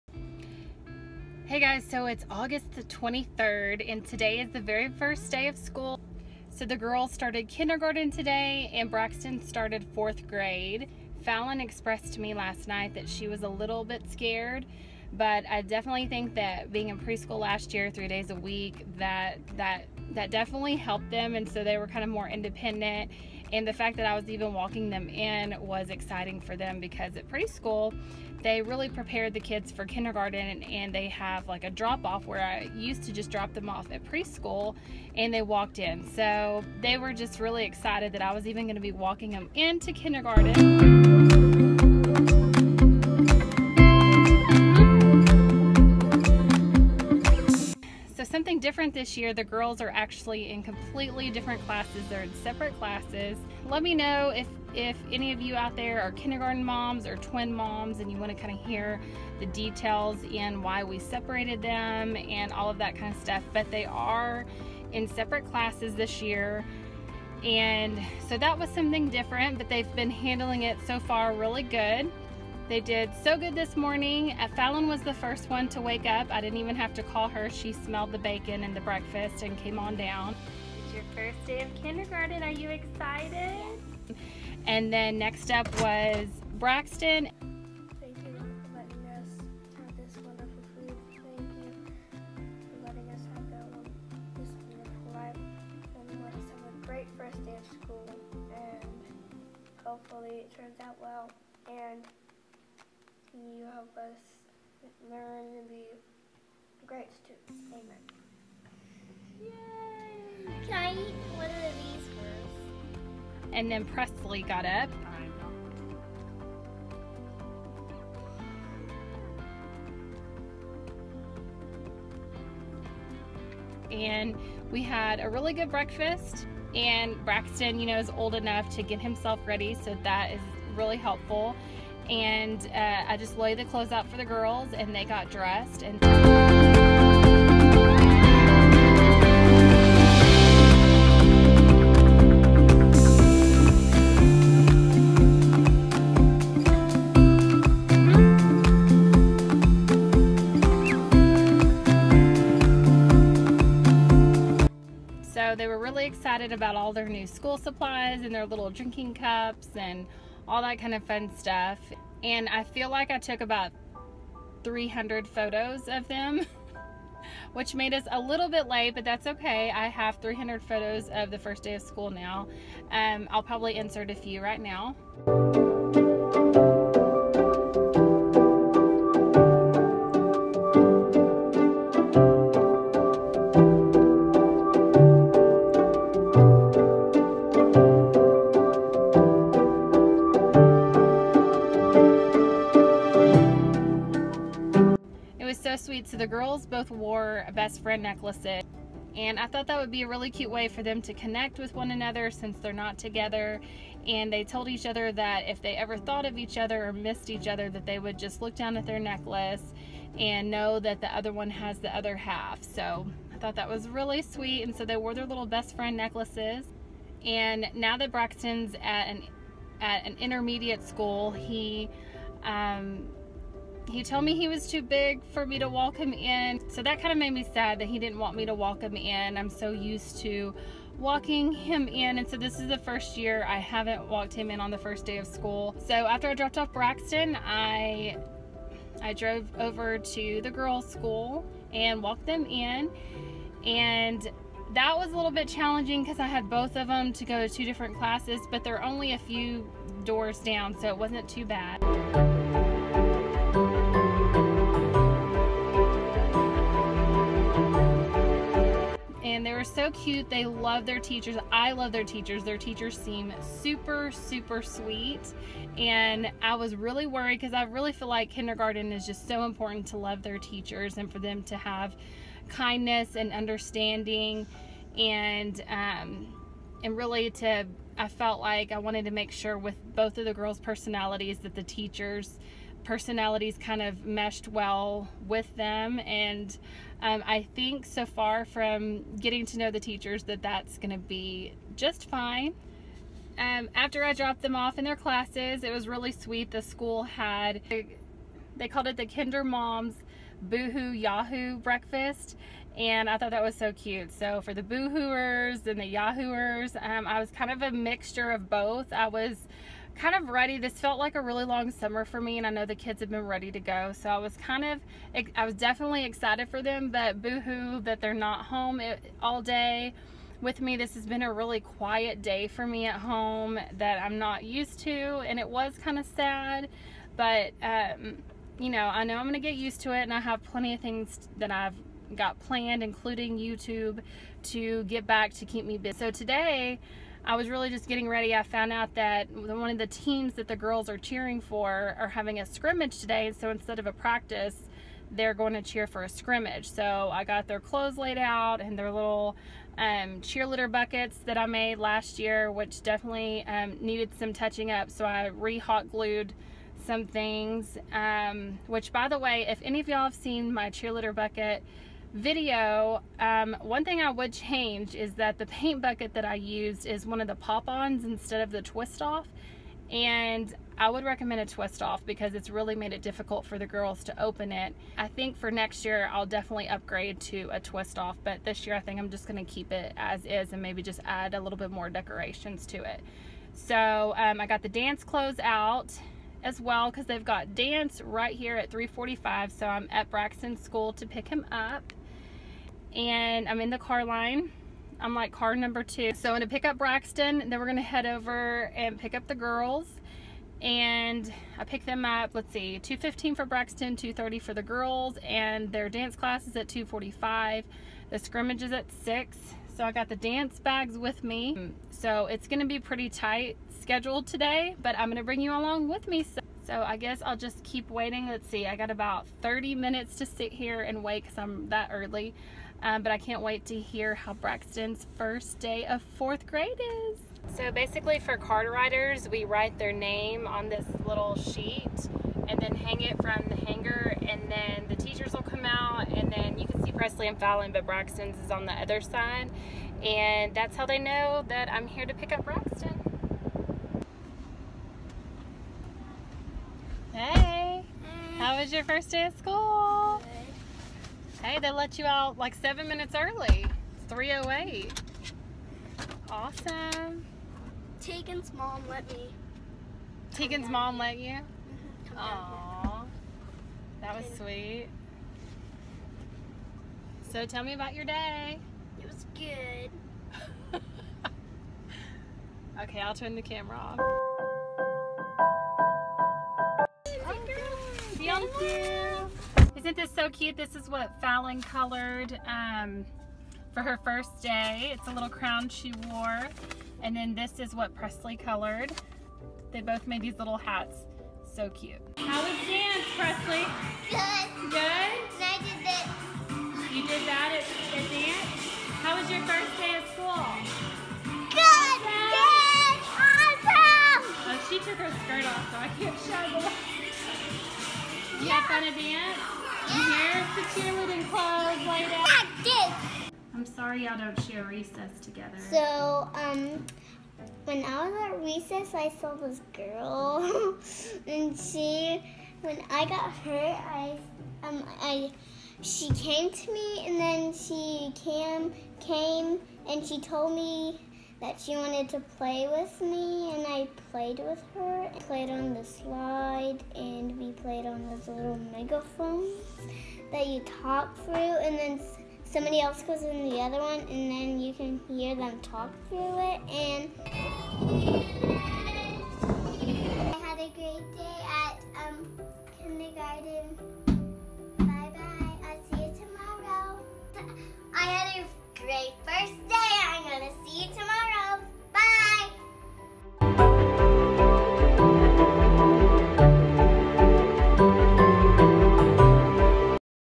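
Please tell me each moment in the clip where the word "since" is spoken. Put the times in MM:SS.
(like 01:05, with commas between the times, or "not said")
03:22.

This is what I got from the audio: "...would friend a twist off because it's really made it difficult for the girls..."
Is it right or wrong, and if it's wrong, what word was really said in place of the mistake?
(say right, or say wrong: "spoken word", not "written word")
wrong: "recommend", not "friend".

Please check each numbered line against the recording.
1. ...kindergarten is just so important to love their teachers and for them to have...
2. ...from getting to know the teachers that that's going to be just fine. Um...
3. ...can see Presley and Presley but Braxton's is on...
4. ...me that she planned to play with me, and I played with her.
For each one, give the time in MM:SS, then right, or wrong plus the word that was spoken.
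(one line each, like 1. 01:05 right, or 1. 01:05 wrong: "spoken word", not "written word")
1. 04:28 right
2. 04:48 right
3. 07:16 wrong: "Fallon", not "Presley"
4. 08:50 wrong: "wanted", not "planned".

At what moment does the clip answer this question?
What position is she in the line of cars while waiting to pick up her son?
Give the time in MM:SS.
06:35.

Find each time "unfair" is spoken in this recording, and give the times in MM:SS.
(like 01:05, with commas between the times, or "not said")
not said.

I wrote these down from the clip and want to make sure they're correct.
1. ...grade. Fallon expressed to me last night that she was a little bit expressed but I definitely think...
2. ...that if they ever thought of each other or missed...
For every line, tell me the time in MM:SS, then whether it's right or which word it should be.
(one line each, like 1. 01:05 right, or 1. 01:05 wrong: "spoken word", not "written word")
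1. 00:10 wrong: "scared", not "expressed"
2. 03:25 right.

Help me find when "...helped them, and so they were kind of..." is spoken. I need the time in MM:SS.
00:20.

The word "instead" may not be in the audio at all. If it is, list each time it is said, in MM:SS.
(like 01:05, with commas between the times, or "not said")
05:43, 06:08.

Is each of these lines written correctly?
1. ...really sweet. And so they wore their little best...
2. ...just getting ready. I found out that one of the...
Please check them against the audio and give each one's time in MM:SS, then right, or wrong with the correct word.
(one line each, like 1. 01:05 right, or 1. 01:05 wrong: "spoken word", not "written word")
1. 03:33 right
2. 05:37 right.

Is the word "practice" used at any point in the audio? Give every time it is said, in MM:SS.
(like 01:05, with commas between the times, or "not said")
05:43.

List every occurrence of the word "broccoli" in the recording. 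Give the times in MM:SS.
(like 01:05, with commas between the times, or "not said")
not said.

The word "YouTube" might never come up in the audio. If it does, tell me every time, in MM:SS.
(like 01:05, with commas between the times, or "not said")
05:33.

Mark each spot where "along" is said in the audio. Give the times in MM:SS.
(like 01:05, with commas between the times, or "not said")
06:55.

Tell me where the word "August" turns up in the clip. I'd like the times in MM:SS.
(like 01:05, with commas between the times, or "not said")
00:02.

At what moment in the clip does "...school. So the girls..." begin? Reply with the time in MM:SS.
00:05.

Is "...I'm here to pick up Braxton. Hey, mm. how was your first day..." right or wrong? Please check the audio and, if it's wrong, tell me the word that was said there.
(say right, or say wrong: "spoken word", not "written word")
right.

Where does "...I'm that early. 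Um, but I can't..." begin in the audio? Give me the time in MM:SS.
07:01.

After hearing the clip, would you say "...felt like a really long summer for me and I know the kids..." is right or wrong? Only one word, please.
right.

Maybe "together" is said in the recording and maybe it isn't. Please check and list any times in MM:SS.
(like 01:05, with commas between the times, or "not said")
03:22, 08:35.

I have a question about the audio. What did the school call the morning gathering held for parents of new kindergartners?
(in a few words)
Kinder Moms Boohoo Yahoo breakfast.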